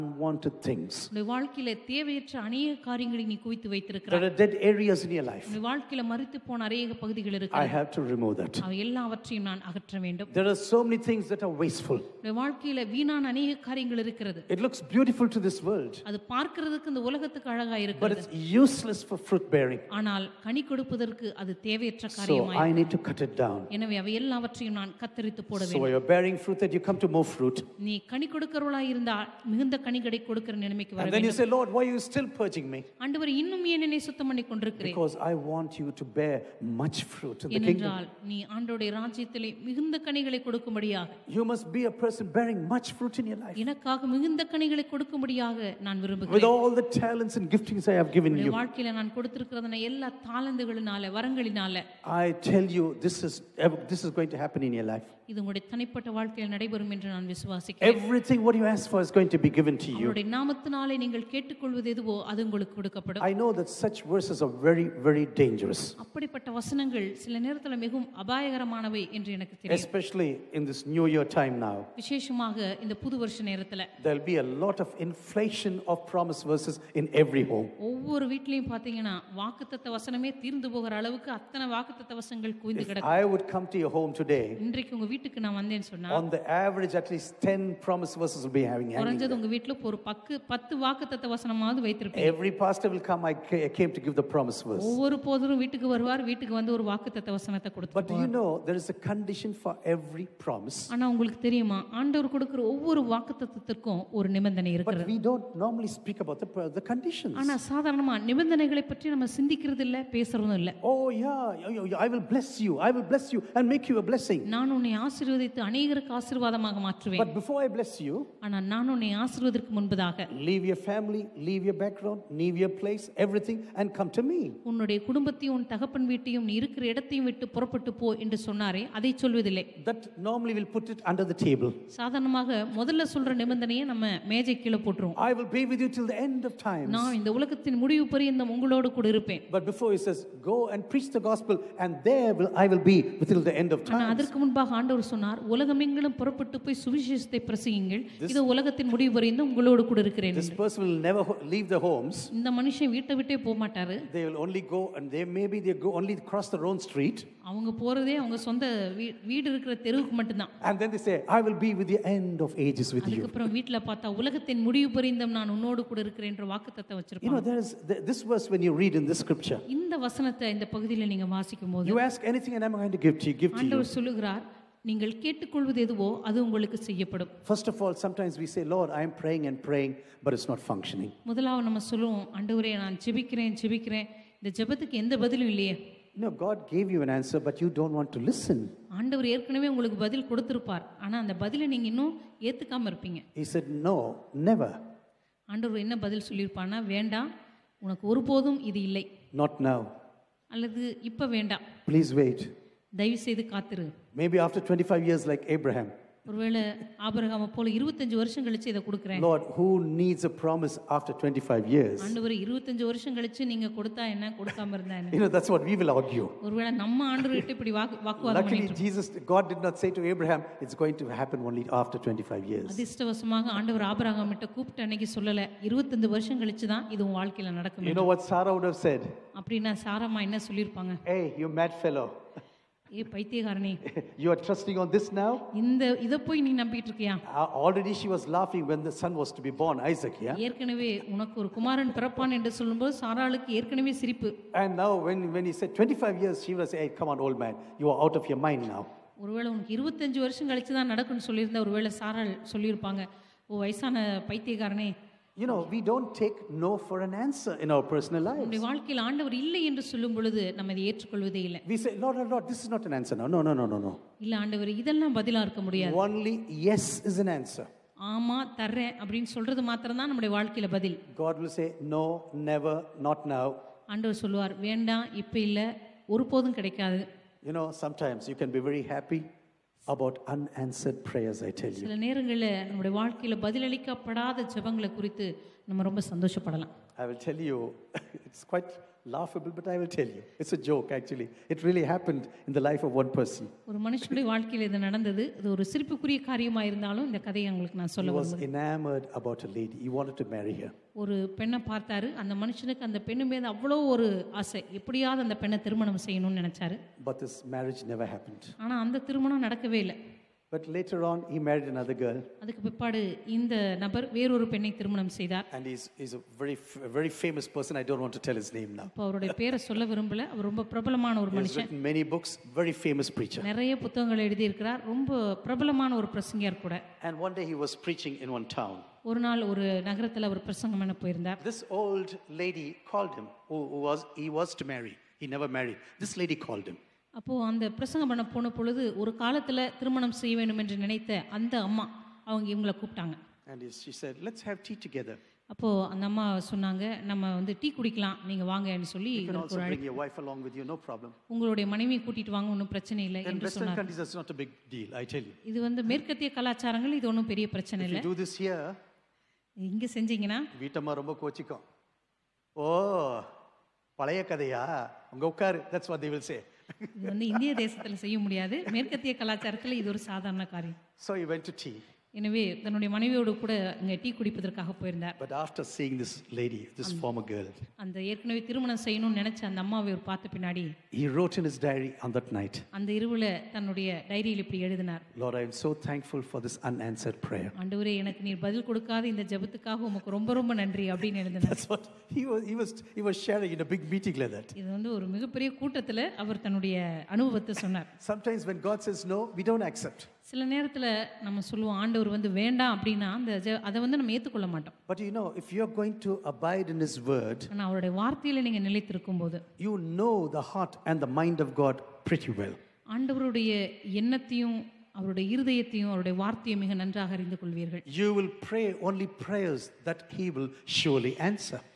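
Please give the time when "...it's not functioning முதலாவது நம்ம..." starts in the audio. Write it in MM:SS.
03:00.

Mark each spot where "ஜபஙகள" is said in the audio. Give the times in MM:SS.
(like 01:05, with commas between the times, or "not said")
04:44.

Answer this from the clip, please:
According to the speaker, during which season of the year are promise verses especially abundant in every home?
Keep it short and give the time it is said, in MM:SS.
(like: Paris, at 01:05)
New year, at 01:10.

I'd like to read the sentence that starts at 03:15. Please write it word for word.
ஆண்டவர் என்ன பதில் சொல்லியிருப்பானா வேண்டாம் உனக்கு ஒருபோதும் இது இல்லை Not now.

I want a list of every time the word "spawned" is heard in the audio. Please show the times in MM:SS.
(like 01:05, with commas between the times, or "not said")
not said.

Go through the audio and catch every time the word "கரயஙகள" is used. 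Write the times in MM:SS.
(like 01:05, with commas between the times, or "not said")
00:02, 00:13.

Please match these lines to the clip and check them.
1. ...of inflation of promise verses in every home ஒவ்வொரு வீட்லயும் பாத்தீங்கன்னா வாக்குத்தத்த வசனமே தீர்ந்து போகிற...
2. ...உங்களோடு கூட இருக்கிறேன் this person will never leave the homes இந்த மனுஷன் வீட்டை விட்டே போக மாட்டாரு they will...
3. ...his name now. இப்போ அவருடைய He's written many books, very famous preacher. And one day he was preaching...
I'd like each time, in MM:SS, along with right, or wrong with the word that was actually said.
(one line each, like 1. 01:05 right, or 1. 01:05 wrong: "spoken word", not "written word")
1. 01:14 right
2. 02:29 right
3. 05:18 right.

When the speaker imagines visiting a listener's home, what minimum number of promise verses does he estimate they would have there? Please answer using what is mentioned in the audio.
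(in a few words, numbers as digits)
10.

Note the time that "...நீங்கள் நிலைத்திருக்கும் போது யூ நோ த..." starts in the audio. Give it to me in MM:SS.
06:48.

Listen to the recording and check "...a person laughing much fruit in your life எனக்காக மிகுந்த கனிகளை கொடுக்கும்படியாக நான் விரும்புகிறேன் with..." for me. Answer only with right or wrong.
wrong.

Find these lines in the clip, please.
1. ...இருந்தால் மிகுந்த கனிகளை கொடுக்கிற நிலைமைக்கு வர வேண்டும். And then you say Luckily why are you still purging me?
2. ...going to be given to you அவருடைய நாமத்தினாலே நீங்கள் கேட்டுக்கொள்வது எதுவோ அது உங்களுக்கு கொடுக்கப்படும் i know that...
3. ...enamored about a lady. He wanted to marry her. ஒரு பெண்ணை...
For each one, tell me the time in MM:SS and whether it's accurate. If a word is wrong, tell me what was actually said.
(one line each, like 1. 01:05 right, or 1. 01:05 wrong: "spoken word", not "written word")
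1. 00:28 wrong: "Lord", not "Luckily"
2. 00:59 right
3. 04:58 right.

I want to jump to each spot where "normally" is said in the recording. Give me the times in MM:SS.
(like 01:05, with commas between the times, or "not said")
01:45, 02:10.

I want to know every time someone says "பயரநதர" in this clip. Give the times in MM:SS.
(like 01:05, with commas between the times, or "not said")
05:31, 06:14.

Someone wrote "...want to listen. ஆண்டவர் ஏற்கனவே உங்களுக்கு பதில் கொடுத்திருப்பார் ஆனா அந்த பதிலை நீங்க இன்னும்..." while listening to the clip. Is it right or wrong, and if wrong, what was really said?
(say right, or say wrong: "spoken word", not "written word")
right.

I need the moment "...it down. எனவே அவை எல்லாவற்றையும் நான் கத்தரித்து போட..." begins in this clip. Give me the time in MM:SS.
00:23.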